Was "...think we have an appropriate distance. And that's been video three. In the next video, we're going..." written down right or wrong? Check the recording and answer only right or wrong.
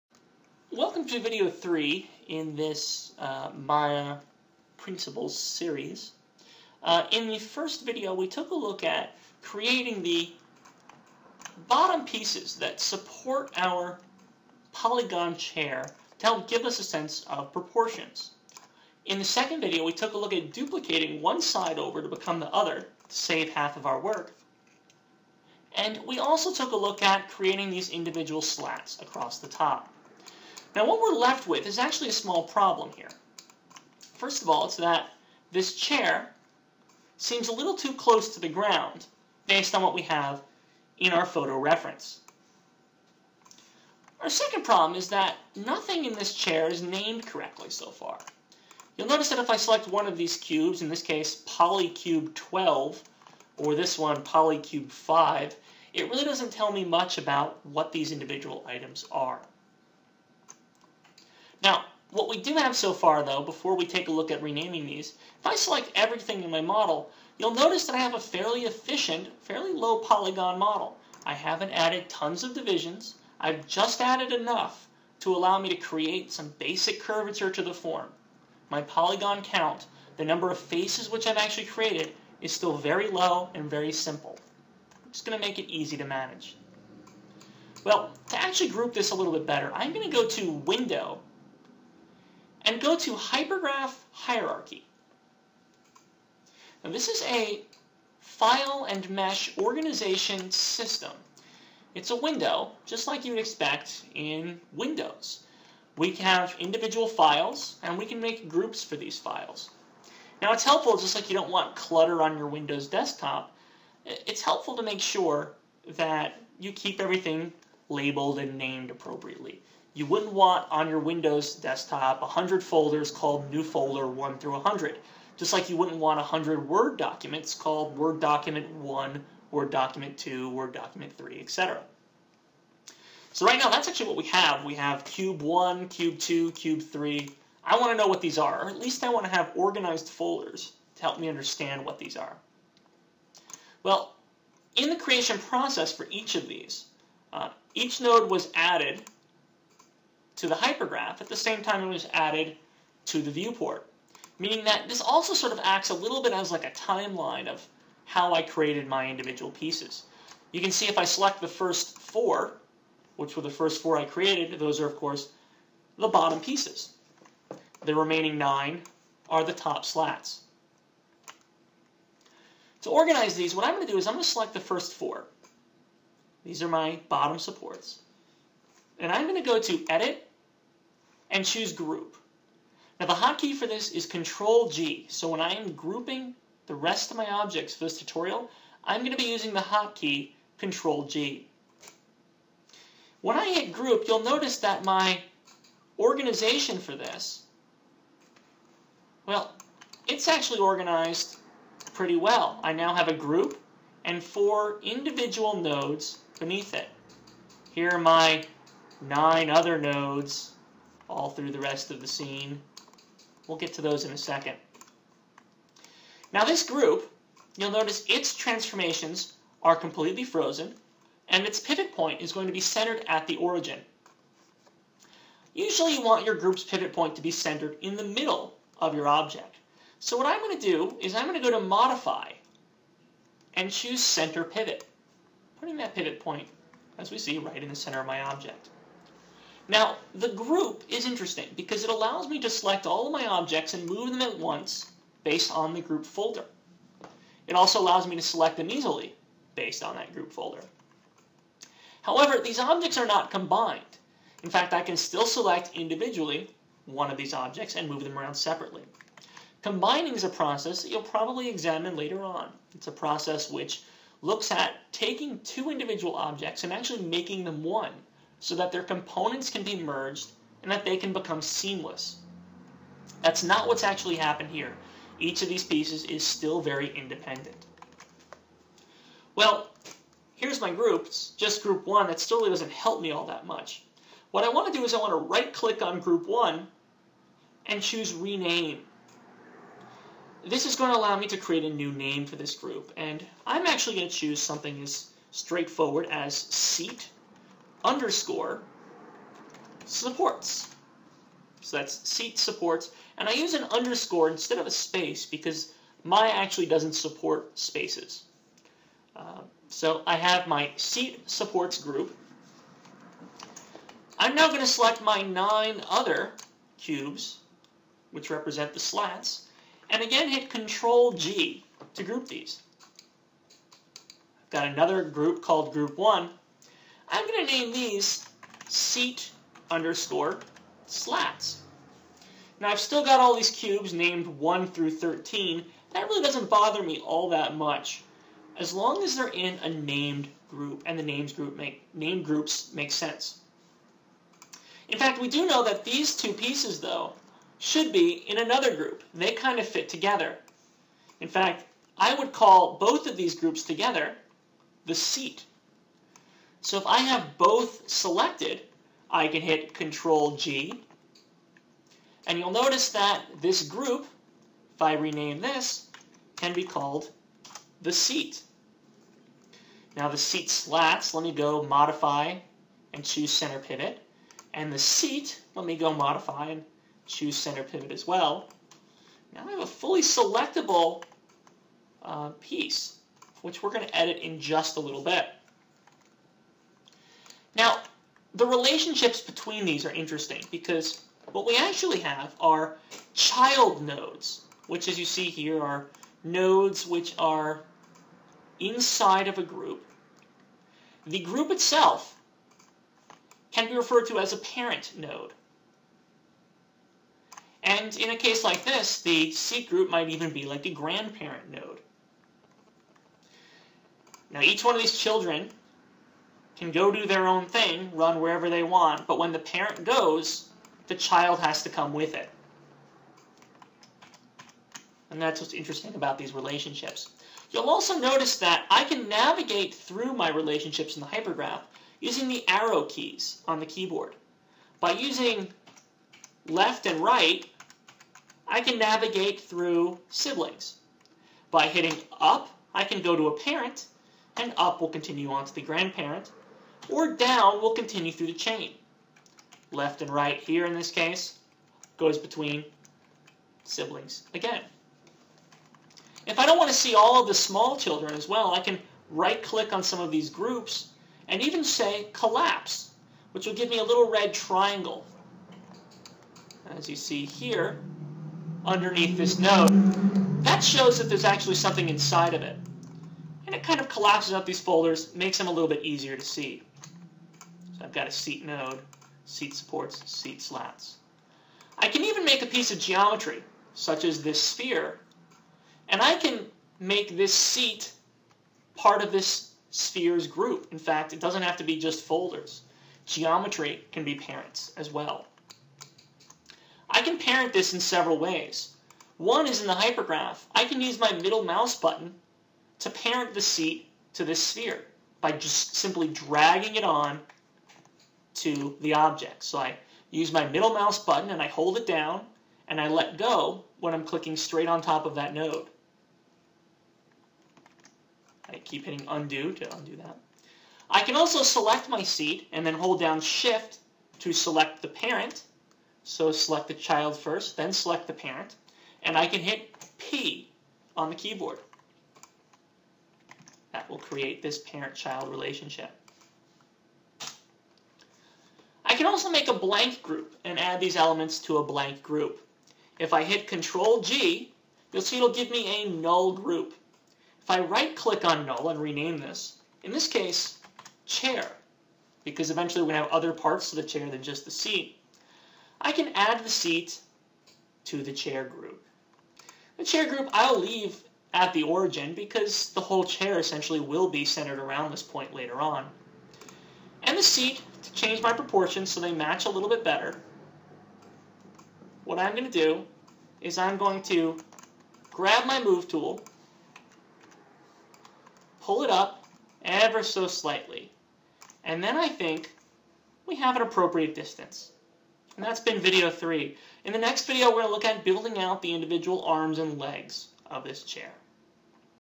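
right.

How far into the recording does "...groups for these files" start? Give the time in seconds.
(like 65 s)
108 s.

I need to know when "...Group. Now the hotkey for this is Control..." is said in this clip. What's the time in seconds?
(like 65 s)
181 s.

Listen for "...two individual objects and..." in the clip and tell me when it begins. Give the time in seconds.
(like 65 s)
265 s.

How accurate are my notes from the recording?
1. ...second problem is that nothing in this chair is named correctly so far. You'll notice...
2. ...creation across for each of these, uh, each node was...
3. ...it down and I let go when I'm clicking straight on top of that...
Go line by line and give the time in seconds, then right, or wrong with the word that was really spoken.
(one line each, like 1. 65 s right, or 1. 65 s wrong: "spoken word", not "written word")
1. 44 s right
2. 144 s wrong: "process", not "across"
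3. 511 s right.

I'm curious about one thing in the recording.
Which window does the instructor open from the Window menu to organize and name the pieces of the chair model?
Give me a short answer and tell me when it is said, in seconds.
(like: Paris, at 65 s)
Hypergraph hierarchy, at 93 s.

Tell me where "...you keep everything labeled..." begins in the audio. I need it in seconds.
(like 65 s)
116 s.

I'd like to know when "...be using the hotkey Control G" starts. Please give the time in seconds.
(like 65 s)
189 s.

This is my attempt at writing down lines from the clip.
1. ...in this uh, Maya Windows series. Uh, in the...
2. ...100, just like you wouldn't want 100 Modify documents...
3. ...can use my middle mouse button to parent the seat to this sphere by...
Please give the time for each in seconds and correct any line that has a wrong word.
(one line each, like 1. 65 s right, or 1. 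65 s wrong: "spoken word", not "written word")
1. 2 s wrong: "Principles", not "Windows"
2. 124 s wrong: "Word", not "Modify"
3. 500 s right.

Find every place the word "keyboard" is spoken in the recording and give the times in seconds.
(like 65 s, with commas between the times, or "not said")
433 s, 531 s.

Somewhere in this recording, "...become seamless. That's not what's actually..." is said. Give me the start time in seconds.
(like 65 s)
271 s.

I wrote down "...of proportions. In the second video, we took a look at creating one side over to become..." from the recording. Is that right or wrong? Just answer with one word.
wrong.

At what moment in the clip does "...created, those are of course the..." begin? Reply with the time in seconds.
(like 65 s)
164 s.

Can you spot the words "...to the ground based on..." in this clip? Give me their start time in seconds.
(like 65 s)
38 s.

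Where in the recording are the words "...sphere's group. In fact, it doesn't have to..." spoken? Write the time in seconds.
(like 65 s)
489 s.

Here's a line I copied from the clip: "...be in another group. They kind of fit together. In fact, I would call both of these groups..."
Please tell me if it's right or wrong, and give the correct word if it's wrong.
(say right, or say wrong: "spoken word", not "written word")
right.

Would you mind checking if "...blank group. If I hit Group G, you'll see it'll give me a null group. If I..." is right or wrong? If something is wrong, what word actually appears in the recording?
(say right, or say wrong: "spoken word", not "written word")
wrong: "Control", not "Group".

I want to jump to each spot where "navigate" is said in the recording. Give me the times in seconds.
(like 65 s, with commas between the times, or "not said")
429 s, 438 s.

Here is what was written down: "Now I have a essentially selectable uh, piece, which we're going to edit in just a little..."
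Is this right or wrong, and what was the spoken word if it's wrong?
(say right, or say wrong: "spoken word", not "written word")
wrong: "fully", not "essentially".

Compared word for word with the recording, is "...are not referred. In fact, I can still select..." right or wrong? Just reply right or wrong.
wrong.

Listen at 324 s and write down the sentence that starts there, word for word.
I've got another group called Group 1, I'm going to name these seat underscore slats.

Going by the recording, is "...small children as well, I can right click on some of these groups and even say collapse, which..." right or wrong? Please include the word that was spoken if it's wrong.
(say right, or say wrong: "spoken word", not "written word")
right.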